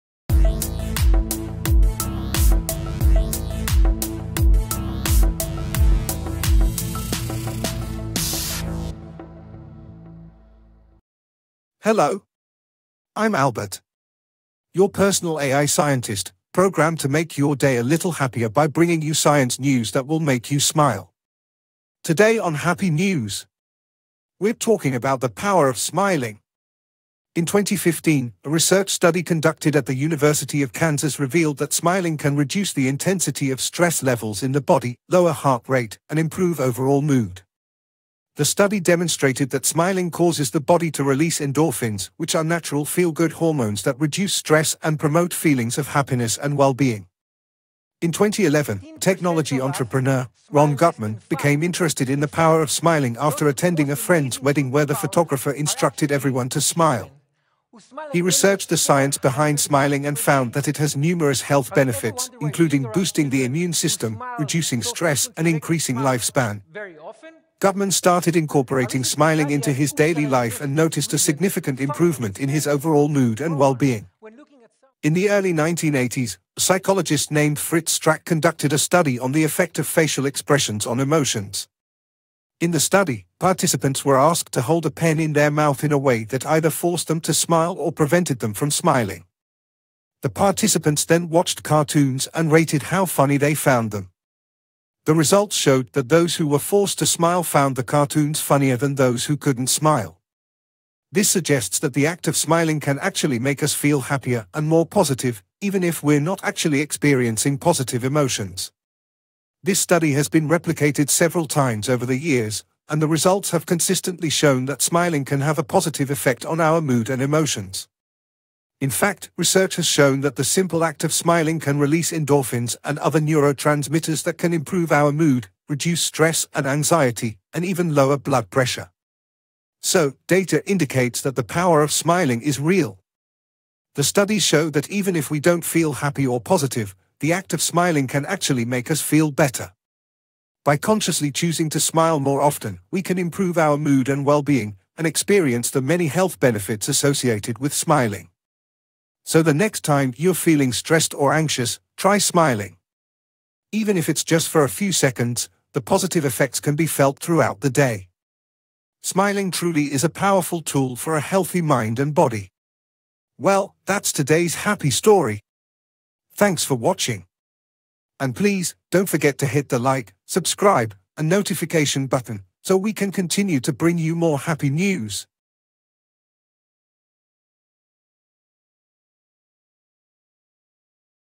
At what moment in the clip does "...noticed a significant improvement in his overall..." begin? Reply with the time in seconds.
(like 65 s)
70 s.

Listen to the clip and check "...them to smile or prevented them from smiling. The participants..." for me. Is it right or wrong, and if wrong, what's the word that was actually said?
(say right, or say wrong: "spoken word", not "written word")
right.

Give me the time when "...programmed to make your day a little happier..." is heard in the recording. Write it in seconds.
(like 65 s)
16 s.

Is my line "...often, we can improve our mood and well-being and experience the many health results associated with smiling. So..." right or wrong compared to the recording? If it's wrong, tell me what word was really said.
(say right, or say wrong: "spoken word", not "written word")
wrong: "benefits", not "results".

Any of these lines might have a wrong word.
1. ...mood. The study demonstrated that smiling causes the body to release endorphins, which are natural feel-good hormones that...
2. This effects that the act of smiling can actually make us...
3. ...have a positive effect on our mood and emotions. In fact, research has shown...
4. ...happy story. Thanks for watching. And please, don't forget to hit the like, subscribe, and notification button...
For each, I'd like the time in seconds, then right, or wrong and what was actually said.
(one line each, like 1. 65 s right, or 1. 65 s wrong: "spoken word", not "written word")
1. 37 s right
2. 101 s wrong: "suggests", not "effects"
3. 115 s right
4. 164 s right.